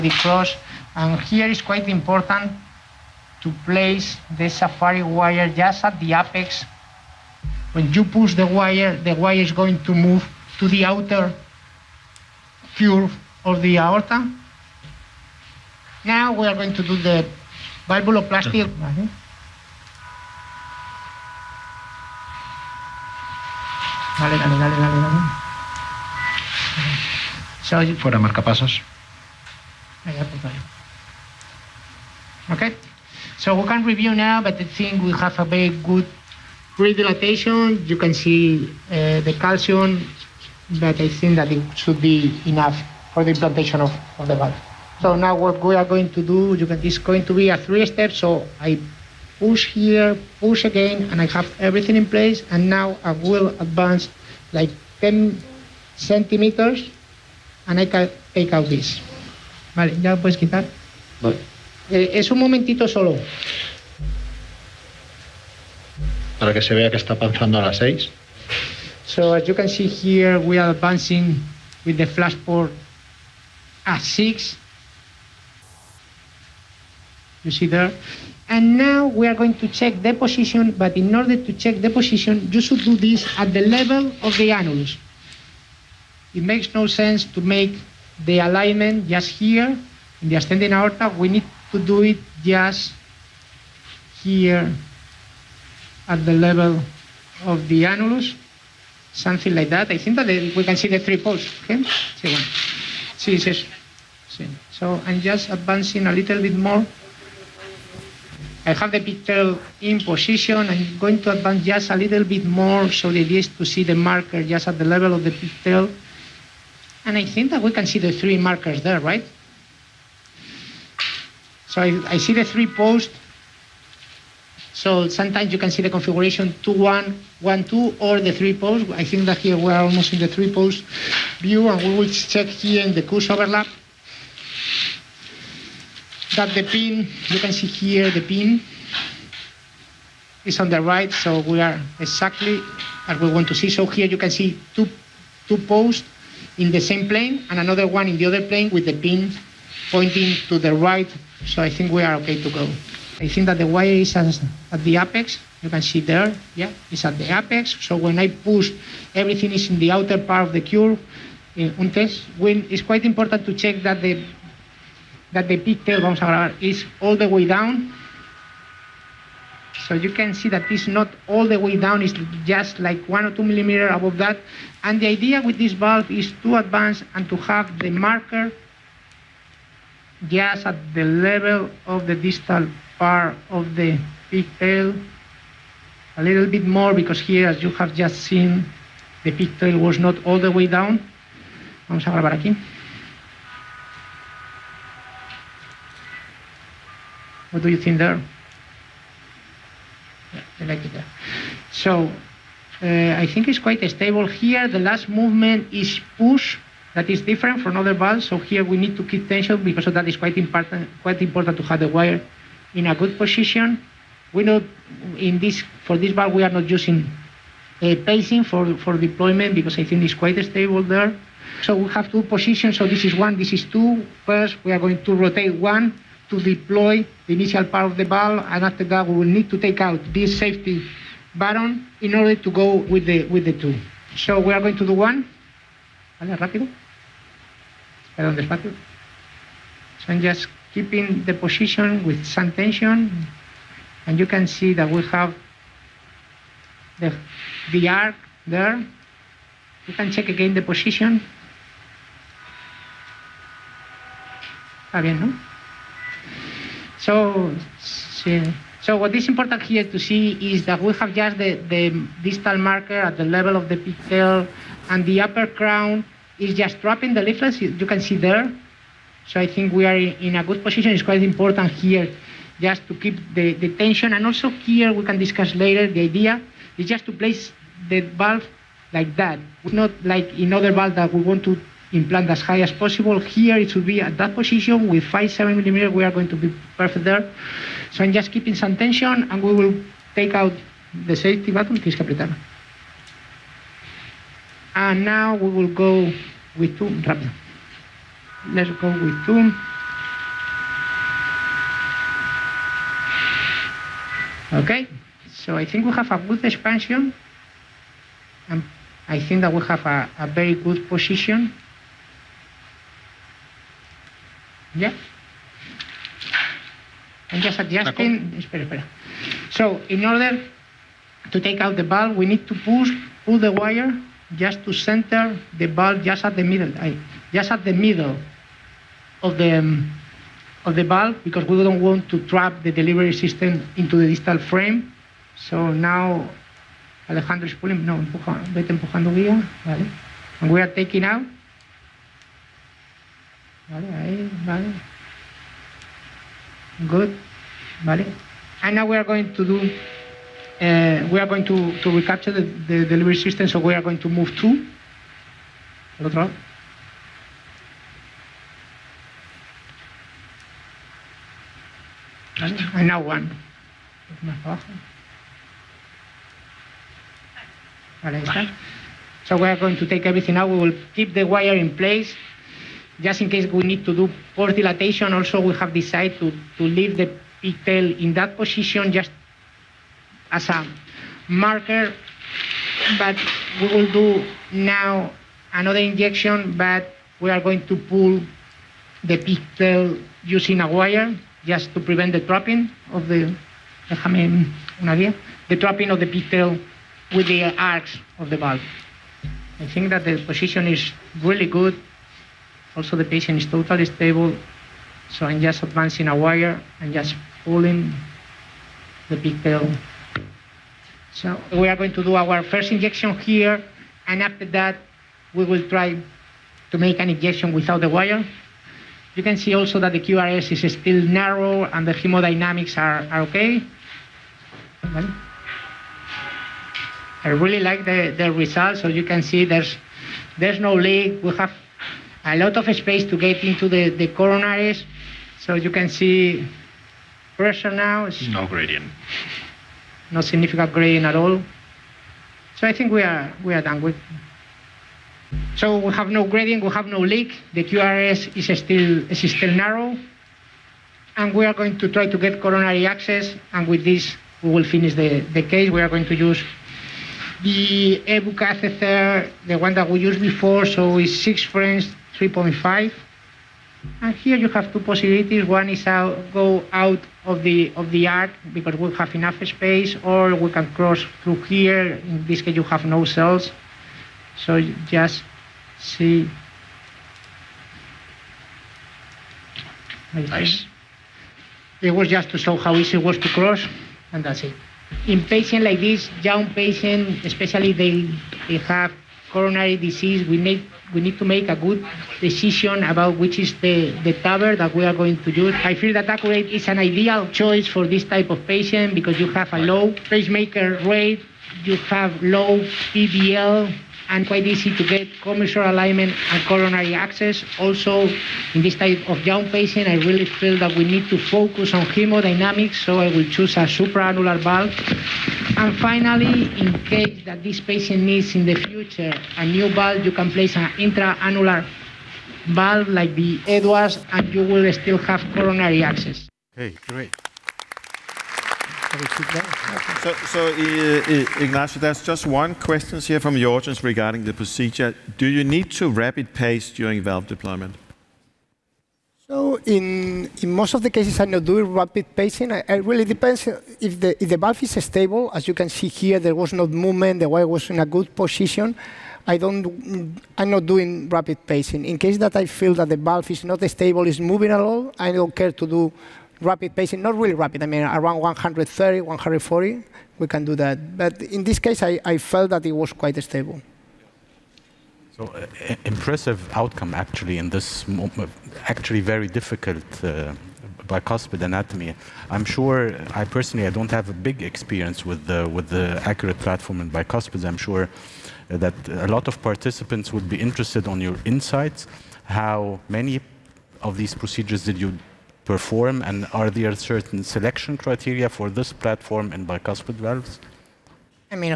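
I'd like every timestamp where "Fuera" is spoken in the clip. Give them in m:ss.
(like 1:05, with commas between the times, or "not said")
0:27.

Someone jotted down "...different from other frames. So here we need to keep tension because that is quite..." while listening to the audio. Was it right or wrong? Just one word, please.
wrong.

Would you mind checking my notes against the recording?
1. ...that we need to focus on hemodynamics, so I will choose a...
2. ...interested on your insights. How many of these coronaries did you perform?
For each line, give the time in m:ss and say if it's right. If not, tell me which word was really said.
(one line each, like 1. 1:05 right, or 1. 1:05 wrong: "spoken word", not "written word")
1. 8:30 right
2. 9:40 wrong: "procedures", not "coronaries".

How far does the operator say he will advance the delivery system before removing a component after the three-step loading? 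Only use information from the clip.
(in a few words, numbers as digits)
10 centimeters.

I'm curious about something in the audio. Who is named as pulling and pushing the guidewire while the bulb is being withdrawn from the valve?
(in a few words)
Alejandro.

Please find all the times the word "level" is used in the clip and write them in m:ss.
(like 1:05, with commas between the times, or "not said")
1:23, 1:36, 1:54, 3:01, 4:23.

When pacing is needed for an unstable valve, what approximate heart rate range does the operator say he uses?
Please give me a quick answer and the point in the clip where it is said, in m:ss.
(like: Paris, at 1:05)
130 to 140, at 9:18.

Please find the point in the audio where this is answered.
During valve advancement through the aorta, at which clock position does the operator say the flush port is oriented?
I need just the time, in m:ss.
1:12.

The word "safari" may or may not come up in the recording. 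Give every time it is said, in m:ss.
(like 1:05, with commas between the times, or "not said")
0:04.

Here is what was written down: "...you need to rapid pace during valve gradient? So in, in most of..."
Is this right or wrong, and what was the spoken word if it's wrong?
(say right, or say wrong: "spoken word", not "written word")
wrong: "deployment", not "gradient".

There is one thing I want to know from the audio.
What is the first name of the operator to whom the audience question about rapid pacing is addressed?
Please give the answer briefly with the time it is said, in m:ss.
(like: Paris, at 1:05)
Ignacio, at 8:51.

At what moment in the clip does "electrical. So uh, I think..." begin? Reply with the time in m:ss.
3:20.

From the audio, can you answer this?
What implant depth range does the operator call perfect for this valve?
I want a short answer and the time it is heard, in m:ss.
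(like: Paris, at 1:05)
5 to 7 millimeters, at 4:45.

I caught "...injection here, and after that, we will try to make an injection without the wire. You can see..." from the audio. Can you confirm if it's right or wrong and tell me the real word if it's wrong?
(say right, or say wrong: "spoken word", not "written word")
right.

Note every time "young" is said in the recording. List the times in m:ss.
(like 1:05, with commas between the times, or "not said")
8:06, 8:29.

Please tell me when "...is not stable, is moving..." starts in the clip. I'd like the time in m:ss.
9:13.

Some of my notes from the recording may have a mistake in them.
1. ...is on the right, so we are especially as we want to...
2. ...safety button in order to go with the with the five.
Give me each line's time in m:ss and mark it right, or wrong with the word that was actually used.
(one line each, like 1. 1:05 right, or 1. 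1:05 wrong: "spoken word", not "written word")
1. 2:20 wrong: "exactly", not "especially"
2. 3:50 wrong: "two", not "five".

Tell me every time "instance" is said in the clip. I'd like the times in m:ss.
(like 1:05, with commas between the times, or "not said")
not said.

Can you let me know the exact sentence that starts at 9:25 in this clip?
So uh, impressive outcome actually in this uh, actually very difficult uh, bicuspid anatomy.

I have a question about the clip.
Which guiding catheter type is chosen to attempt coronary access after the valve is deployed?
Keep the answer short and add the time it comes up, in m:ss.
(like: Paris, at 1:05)
EBU, at 7:38.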